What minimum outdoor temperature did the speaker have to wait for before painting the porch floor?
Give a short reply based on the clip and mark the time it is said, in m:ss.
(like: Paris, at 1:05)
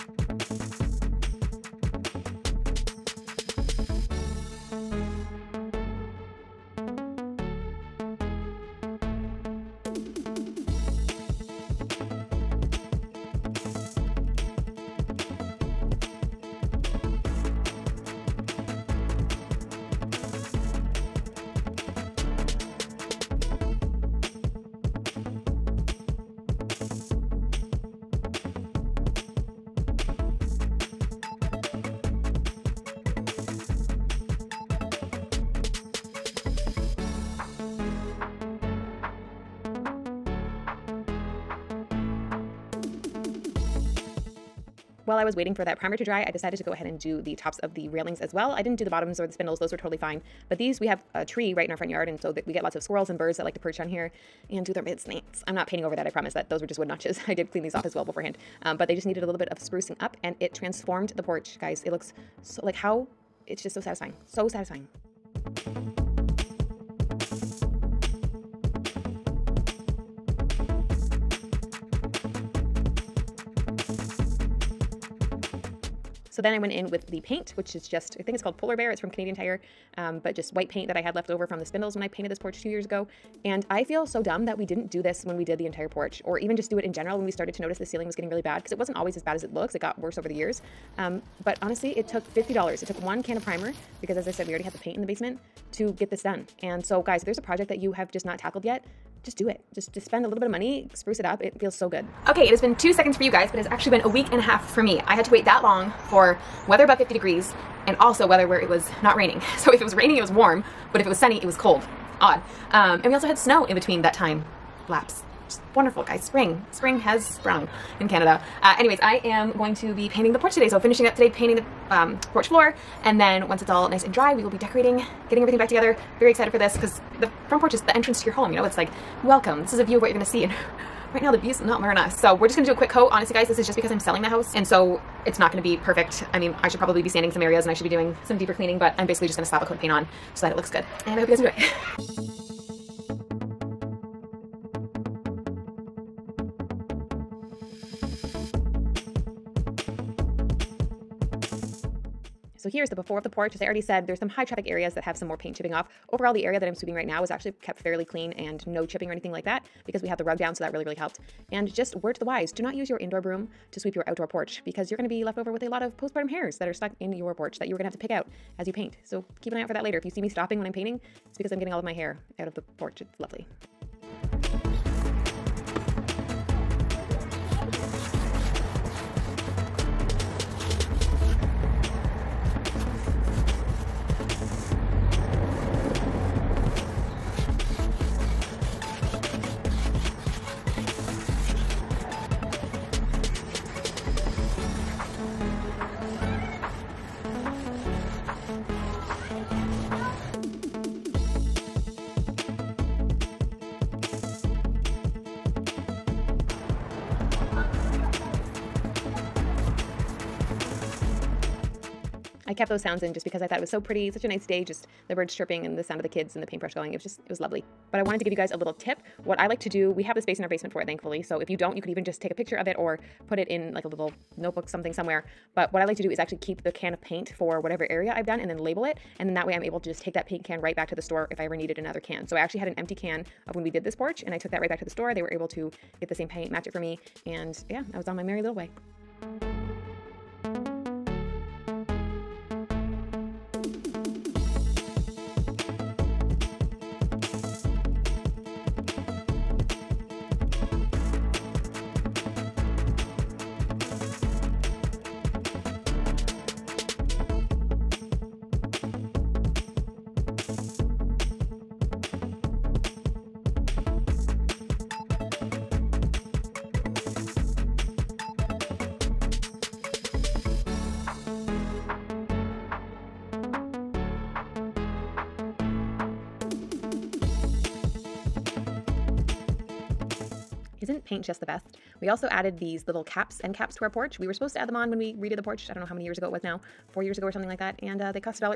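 50 degrees, at 1:46.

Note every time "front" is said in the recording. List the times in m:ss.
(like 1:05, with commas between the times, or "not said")
0:51, 2:07.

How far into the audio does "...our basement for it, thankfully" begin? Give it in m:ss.
3:40.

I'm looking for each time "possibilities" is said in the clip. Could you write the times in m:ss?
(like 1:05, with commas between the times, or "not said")
not said.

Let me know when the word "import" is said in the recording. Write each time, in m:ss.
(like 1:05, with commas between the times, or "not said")
not said.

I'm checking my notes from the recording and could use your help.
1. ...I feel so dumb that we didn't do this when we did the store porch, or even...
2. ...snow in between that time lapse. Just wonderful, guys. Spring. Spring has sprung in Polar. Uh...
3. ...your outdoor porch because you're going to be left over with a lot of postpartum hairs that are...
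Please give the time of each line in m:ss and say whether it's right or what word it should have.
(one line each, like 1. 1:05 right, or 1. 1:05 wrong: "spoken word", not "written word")
1. 1:23 wrong: "entire", not "store"
2. 1:53 wrong: "Canada", not "Polar"
3. 2:43 right.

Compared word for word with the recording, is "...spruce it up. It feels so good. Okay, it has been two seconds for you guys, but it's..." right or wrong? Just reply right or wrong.
right.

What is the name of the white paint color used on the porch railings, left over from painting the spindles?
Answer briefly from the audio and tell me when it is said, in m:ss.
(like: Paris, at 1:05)
Polar Bear, at 1:18.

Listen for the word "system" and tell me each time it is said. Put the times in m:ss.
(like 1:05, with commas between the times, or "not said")
not said.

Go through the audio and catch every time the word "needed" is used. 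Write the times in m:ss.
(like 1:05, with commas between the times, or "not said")
0:59, 3:51.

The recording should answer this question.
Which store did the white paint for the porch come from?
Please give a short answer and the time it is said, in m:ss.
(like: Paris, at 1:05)
Canadian Tire, at 1:19.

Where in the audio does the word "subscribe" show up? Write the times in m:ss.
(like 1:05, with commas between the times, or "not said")
not said.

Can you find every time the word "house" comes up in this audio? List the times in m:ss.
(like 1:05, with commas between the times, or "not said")
2:14.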